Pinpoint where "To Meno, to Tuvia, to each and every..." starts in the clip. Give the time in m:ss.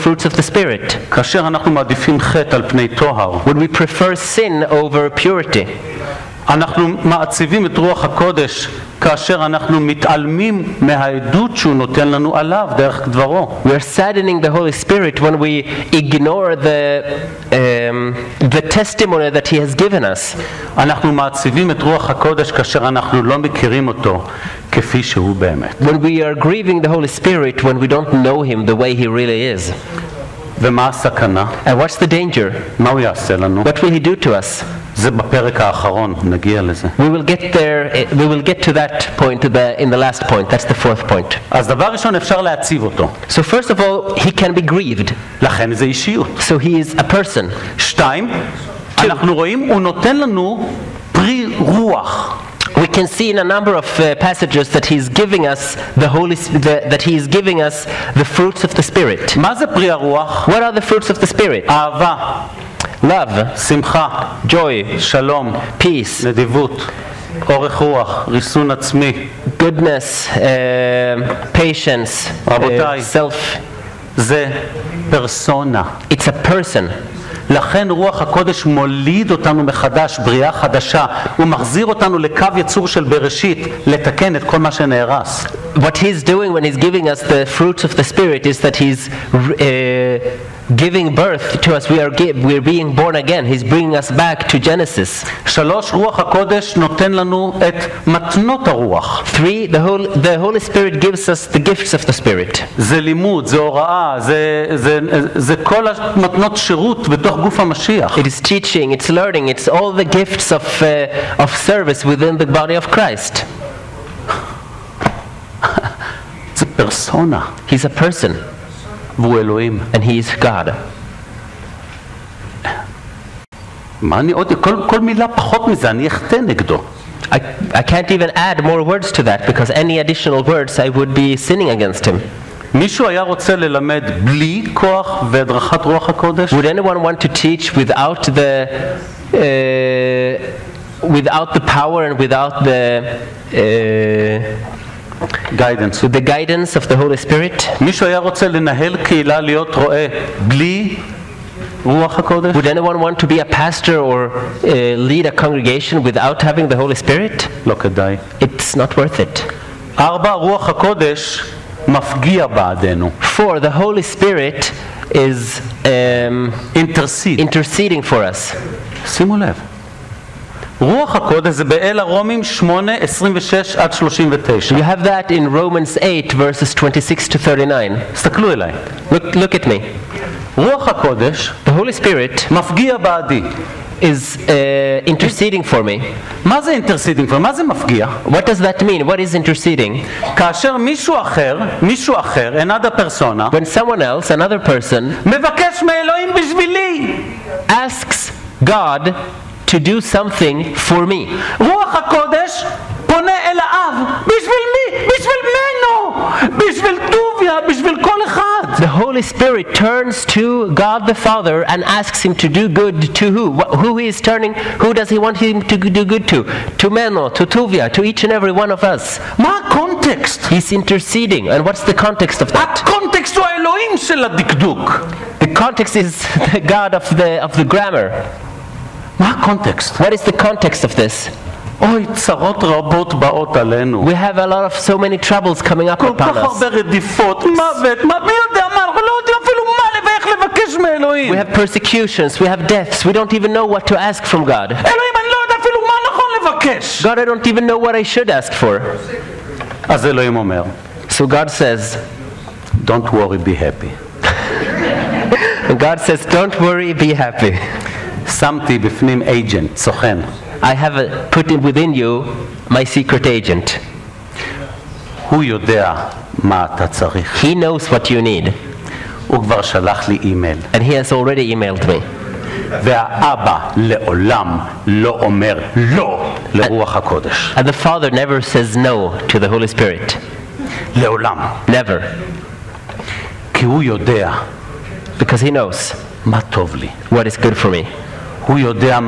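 3:36.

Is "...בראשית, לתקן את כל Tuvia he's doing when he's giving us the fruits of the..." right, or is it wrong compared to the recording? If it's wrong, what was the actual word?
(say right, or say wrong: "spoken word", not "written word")
wrong: "What", not "Tuvia".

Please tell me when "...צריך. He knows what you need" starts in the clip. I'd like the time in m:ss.
4:26.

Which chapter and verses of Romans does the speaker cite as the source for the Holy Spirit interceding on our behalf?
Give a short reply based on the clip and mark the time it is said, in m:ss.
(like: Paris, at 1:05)
Romans 8:26-39, at 2:55.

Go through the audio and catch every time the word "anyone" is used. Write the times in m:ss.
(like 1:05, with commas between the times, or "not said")
2:13, 2:32.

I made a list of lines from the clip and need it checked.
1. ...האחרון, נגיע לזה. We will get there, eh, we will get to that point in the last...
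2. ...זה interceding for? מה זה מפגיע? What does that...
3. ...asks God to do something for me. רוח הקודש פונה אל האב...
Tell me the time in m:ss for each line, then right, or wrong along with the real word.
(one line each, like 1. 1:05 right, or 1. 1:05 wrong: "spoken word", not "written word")
1. 0:35 right
2. 3:06 right
3. 3:17 right.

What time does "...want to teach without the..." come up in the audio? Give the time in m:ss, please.
2:17.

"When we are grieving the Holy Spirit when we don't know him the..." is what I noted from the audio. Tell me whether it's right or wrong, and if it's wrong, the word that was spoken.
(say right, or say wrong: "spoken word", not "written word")
right.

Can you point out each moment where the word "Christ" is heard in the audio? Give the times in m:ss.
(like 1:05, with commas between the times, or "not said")
1:52.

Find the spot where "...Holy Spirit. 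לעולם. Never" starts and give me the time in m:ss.
4:39.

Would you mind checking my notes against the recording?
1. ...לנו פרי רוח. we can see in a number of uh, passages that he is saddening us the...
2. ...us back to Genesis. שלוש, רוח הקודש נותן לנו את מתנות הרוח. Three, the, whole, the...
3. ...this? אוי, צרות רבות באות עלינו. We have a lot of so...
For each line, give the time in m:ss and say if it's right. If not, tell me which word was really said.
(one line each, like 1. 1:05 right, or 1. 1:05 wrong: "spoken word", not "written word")
1. 0:50 wrong: "giving", not "saddening"
2. 1:33 right
3. 3:50 right.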